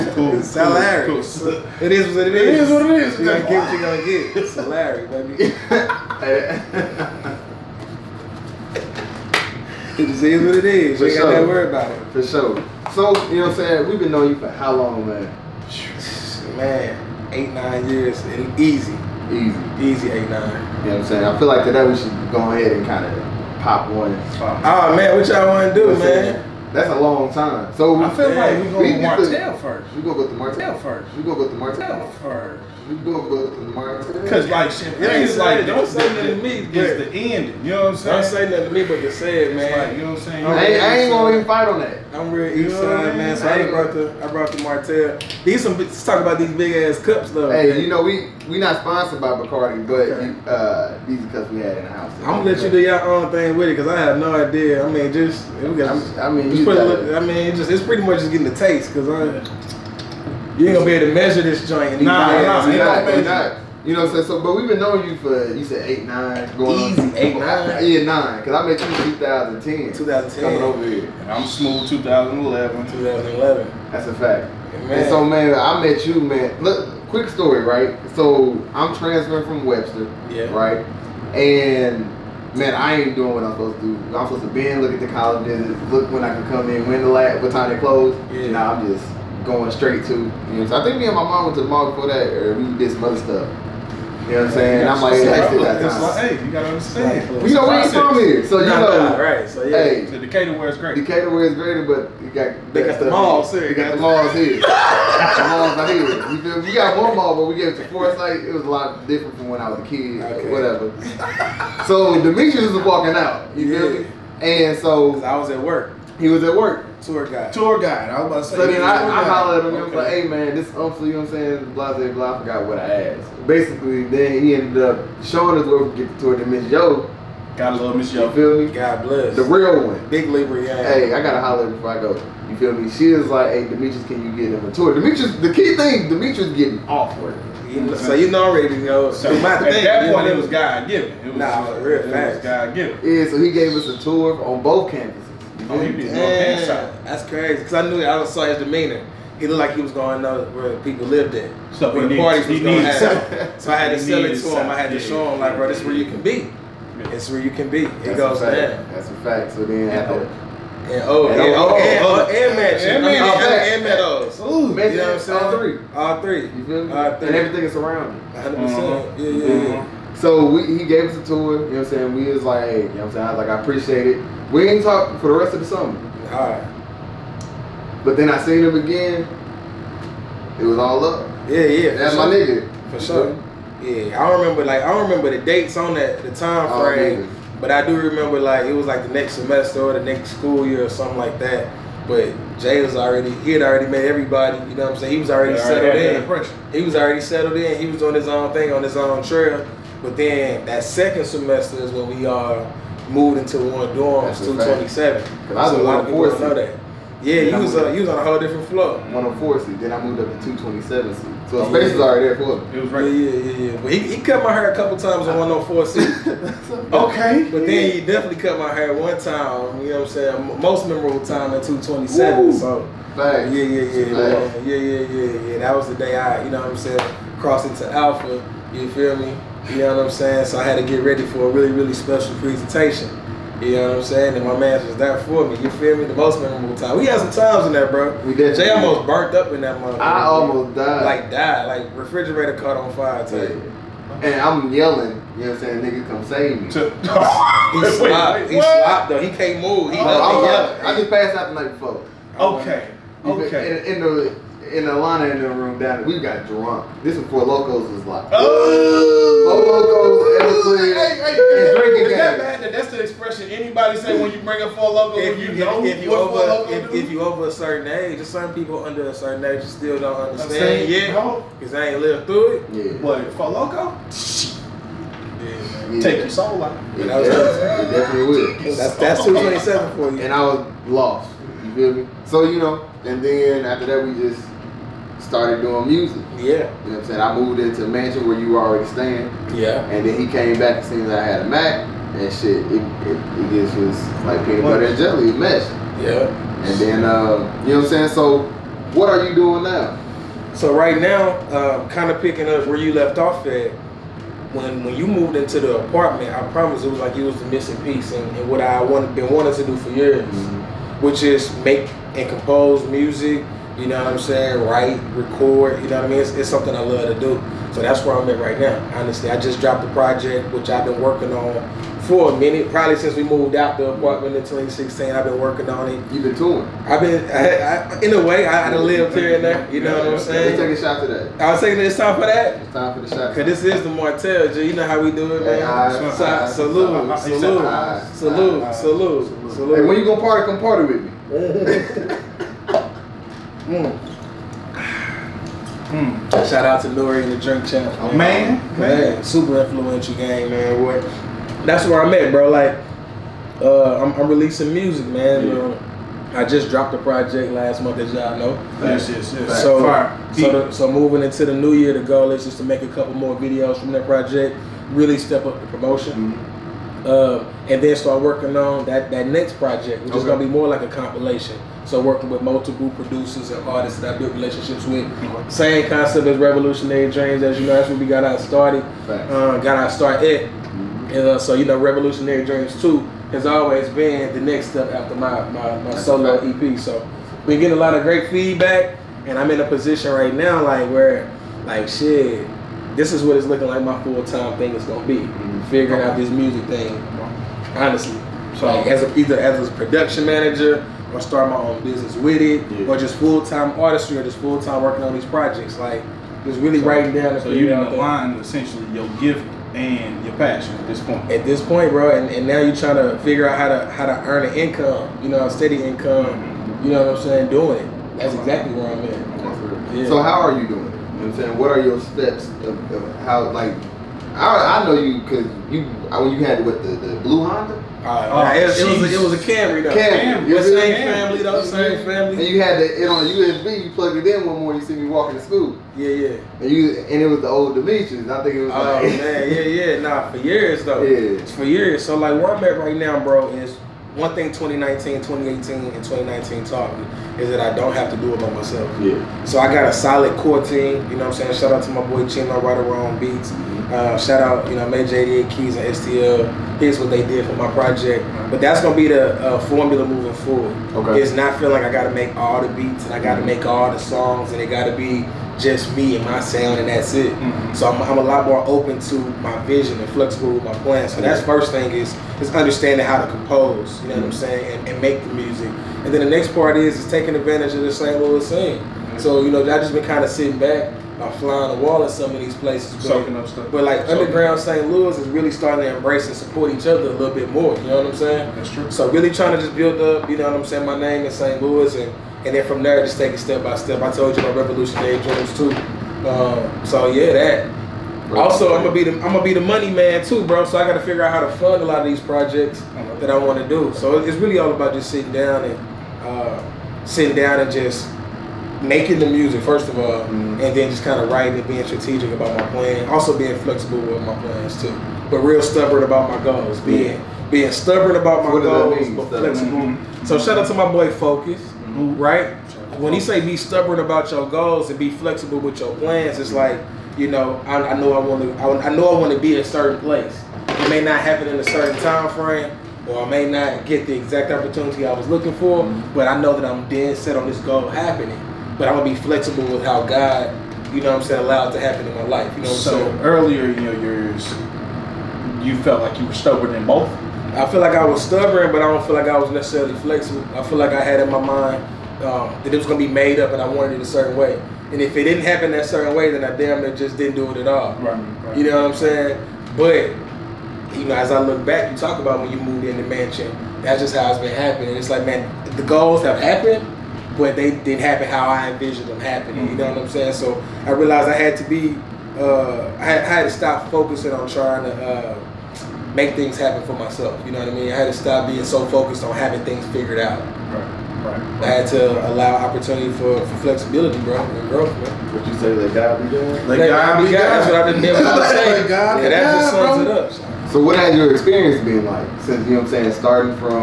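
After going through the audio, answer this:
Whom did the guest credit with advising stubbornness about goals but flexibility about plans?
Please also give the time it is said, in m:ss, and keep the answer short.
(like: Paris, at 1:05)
Focus, at 8:41.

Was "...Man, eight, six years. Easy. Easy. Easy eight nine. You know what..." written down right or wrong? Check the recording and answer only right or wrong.
wrong.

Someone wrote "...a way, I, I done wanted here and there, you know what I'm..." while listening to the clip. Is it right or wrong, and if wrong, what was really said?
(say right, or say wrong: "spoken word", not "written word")
wrong: "lived", not "wanted".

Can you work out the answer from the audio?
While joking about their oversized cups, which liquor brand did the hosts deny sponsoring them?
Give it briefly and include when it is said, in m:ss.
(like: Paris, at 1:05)
Bacardi, at 0:49.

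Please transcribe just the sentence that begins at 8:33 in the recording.
Also being flexible with my plans too, but real stubborn about my goals.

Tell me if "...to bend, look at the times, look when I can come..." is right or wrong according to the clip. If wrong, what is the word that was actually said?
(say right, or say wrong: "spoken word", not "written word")
wrong: "colleges", not "times".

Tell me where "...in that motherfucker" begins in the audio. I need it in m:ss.
3:59.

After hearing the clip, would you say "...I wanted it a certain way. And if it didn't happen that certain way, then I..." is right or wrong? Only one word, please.
right.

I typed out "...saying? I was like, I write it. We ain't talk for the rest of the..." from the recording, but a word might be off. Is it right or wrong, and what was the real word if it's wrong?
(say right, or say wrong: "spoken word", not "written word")
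wrong: "appreciate", not "write".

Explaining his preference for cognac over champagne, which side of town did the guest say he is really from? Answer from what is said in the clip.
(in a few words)
East side.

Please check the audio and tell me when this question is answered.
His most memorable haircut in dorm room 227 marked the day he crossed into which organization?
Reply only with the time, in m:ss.
3:47.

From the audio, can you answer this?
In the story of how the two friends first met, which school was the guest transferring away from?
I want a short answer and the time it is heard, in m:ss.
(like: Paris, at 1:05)
Webster, at 1:19.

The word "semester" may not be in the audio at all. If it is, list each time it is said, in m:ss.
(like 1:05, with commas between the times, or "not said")
3:09, 3:21.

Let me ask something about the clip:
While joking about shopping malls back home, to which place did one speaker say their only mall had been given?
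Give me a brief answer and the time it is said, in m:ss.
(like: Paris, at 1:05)
Forsyth, at 1:47.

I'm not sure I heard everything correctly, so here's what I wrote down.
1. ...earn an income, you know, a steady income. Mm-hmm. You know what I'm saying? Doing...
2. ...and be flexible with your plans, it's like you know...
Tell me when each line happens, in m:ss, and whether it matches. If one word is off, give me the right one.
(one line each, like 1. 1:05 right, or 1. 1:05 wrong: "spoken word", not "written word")
1. 6:54 right
2. 8:44 right.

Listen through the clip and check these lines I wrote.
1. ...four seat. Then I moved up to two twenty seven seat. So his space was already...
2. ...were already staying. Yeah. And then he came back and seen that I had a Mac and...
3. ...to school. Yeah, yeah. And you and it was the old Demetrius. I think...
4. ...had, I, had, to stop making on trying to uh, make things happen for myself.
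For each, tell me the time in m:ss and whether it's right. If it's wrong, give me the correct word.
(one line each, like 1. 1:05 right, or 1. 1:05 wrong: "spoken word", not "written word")
1. 3:29 right
2. 4:48 right
3. 7:15 right
4. 9:33 wrong: "focusing", not "making".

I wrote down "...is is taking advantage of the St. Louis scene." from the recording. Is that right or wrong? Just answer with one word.
right.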